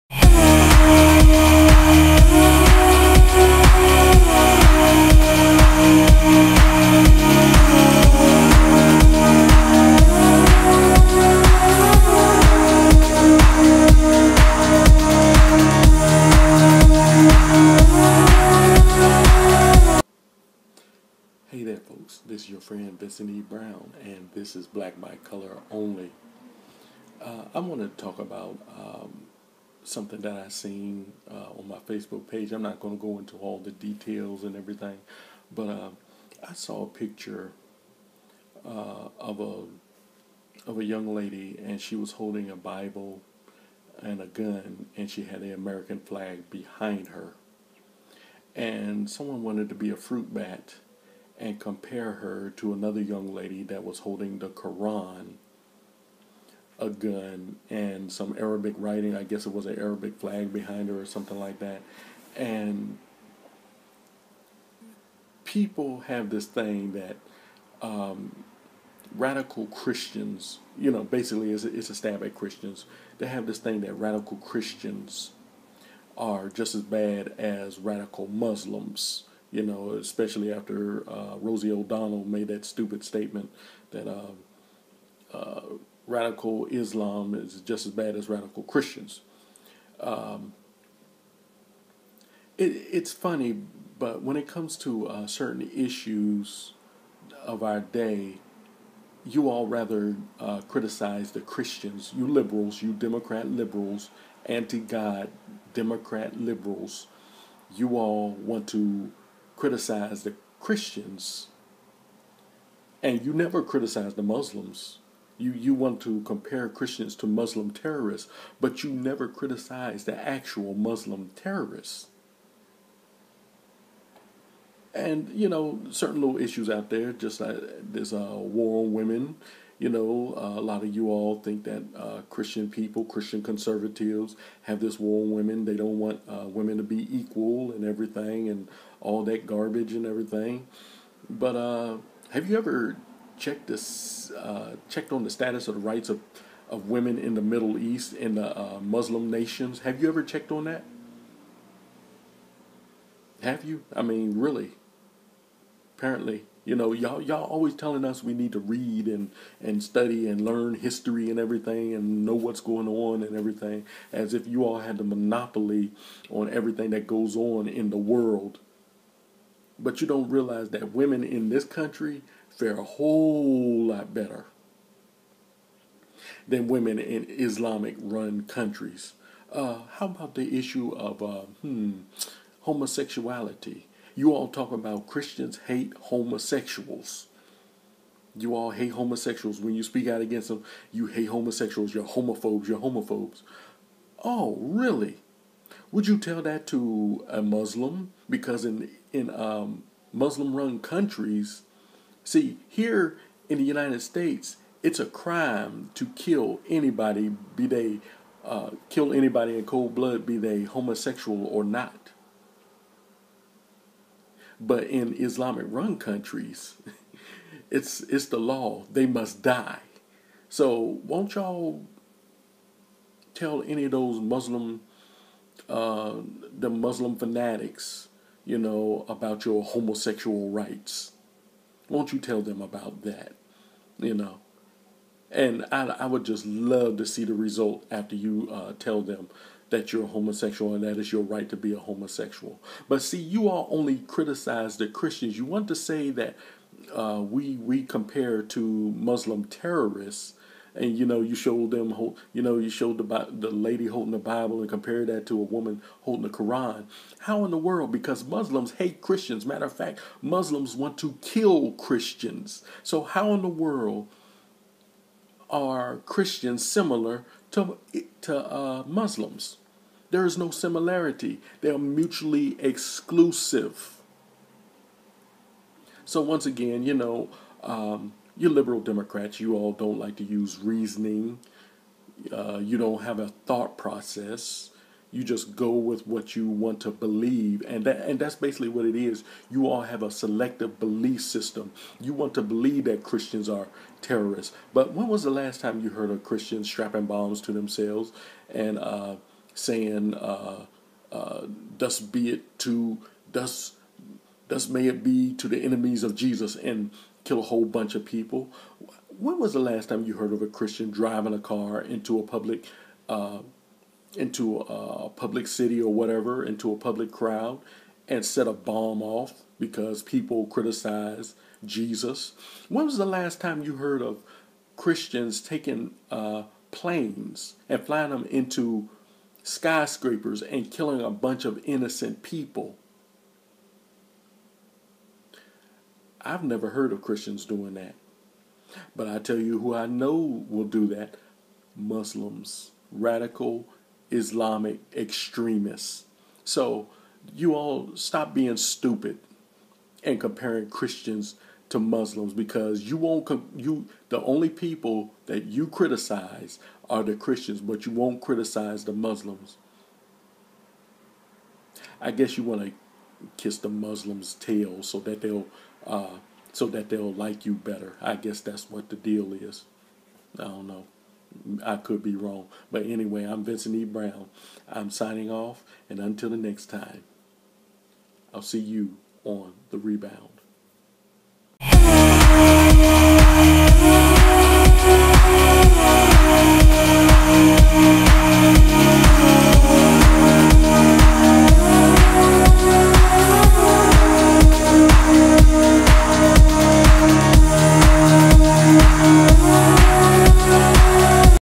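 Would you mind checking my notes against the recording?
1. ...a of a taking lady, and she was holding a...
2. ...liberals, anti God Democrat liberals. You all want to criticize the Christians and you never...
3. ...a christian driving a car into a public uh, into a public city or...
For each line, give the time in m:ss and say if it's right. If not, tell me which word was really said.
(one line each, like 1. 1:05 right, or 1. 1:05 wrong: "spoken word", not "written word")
1. 0:39 wrong: "young", not "taking"
2. 1:43 right
3. 5:10 right.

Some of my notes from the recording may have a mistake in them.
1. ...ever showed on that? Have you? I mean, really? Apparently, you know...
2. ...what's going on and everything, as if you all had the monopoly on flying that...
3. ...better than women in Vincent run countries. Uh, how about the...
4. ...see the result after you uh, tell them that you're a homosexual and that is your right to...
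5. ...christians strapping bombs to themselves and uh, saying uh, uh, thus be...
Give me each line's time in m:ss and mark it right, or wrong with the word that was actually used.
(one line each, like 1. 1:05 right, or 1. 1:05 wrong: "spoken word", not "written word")
1. 2:30 wrong: "checked", not "showed"
2. 2:42 wrong: "everything", not "flying"
3. 2:54 wrong: "Islamic", not "Vincent"
4. 3:57 right
5. 4:56 right.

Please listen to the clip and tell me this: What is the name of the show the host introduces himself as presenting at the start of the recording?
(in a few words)
Black by Color Only.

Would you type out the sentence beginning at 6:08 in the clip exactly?
I guess that's what the deal is.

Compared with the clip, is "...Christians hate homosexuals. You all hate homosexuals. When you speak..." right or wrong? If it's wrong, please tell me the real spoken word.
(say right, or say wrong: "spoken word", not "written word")
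right.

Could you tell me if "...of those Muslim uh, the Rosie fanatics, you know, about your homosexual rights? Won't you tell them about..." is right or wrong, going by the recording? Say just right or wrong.
wrong.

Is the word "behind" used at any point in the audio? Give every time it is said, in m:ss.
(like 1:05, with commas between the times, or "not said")
0:46, 1:00.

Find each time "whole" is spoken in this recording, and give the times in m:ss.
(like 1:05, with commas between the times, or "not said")
2:52, 5:07.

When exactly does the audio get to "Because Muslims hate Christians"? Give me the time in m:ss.
4:17.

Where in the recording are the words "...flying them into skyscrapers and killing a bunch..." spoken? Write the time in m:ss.
5:27.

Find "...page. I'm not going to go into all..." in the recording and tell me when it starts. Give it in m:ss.
0:32.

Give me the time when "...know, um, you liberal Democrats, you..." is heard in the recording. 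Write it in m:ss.
4:36.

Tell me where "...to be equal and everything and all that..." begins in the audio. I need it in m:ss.
2:16.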